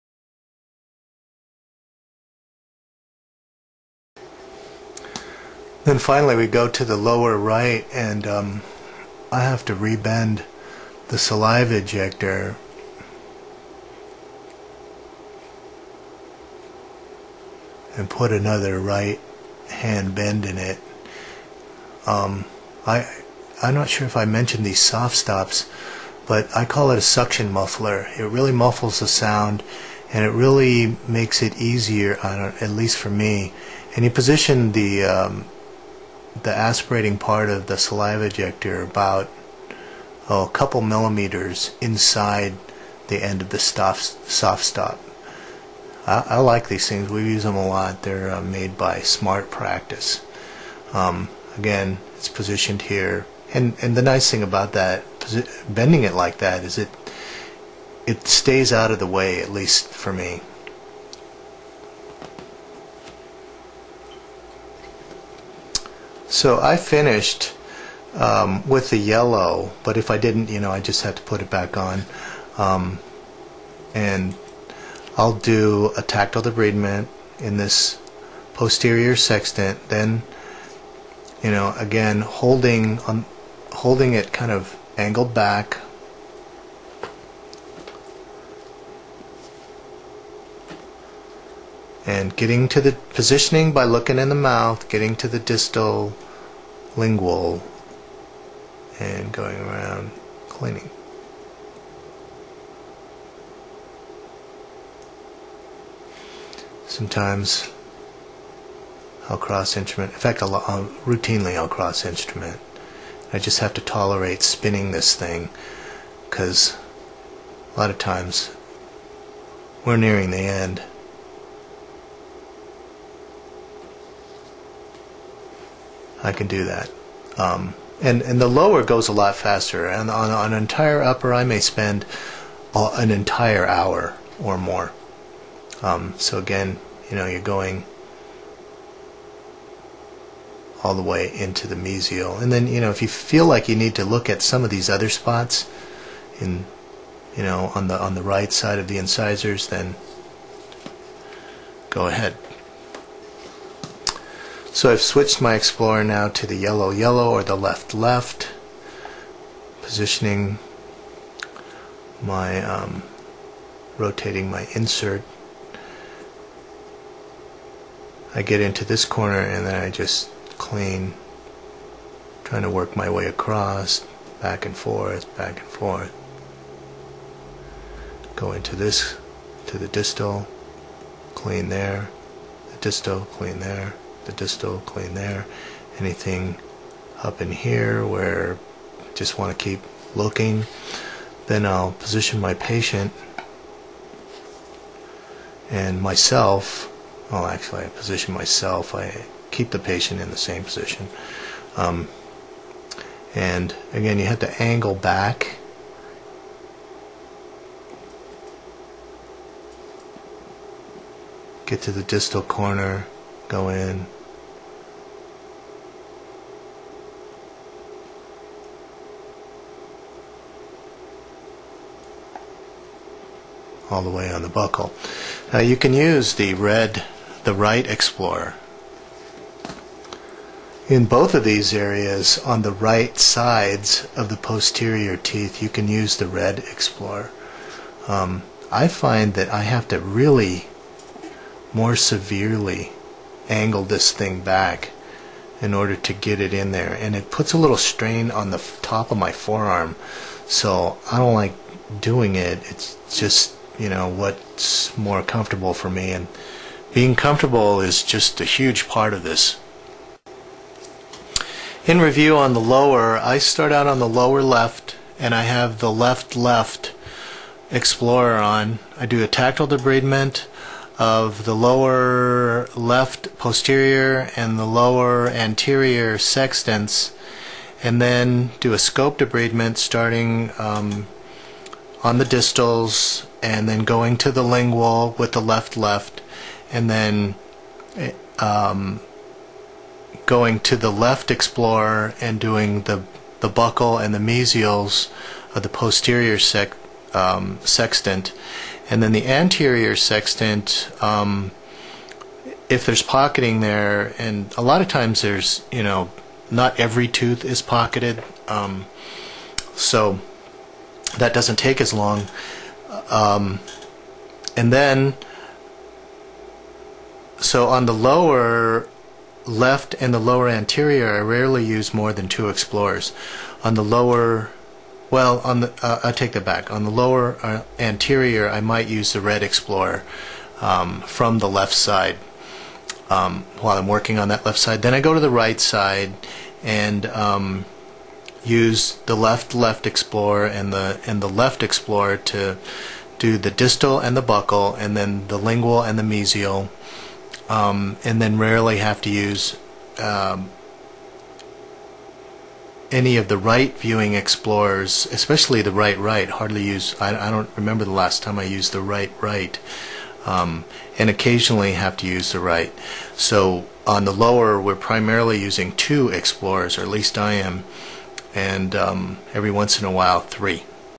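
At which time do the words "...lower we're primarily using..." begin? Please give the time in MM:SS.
06:04.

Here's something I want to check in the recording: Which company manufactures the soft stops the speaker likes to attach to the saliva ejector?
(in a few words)
Smart Practice.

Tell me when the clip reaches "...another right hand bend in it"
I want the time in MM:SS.
00:18.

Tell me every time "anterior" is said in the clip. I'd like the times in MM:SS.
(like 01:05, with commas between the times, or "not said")
04:35, 04:59, 05:20, 05:27.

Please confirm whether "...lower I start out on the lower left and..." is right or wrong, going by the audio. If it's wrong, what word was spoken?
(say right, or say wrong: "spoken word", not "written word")
right.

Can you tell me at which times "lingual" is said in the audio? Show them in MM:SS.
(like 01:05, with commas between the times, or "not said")
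01:36, 04:44, 05:45.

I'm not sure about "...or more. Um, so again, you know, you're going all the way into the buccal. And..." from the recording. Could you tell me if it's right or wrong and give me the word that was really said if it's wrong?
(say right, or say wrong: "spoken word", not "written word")
wrong: "mesial", not "buccal".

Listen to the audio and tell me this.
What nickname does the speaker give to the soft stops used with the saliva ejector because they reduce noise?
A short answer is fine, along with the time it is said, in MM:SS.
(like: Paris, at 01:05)
suction muffler, at 00:27.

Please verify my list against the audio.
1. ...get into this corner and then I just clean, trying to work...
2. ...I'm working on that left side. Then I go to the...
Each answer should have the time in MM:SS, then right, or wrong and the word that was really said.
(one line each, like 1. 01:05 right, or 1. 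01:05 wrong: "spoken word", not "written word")
1. 02:48 right
2. 05:33 right.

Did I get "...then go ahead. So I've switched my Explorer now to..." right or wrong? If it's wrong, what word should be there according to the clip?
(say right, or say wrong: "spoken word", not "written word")
right.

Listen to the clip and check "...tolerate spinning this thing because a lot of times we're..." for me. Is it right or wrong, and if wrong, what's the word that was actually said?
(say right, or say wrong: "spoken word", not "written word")
right.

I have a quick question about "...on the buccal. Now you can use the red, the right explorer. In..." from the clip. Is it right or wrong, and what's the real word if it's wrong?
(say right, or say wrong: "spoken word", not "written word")
right.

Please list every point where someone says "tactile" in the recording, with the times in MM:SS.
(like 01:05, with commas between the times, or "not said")
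01:16, 04:29.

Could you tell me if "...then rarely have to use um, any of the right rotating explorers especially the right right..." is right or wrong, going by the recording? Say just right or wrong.
wrong.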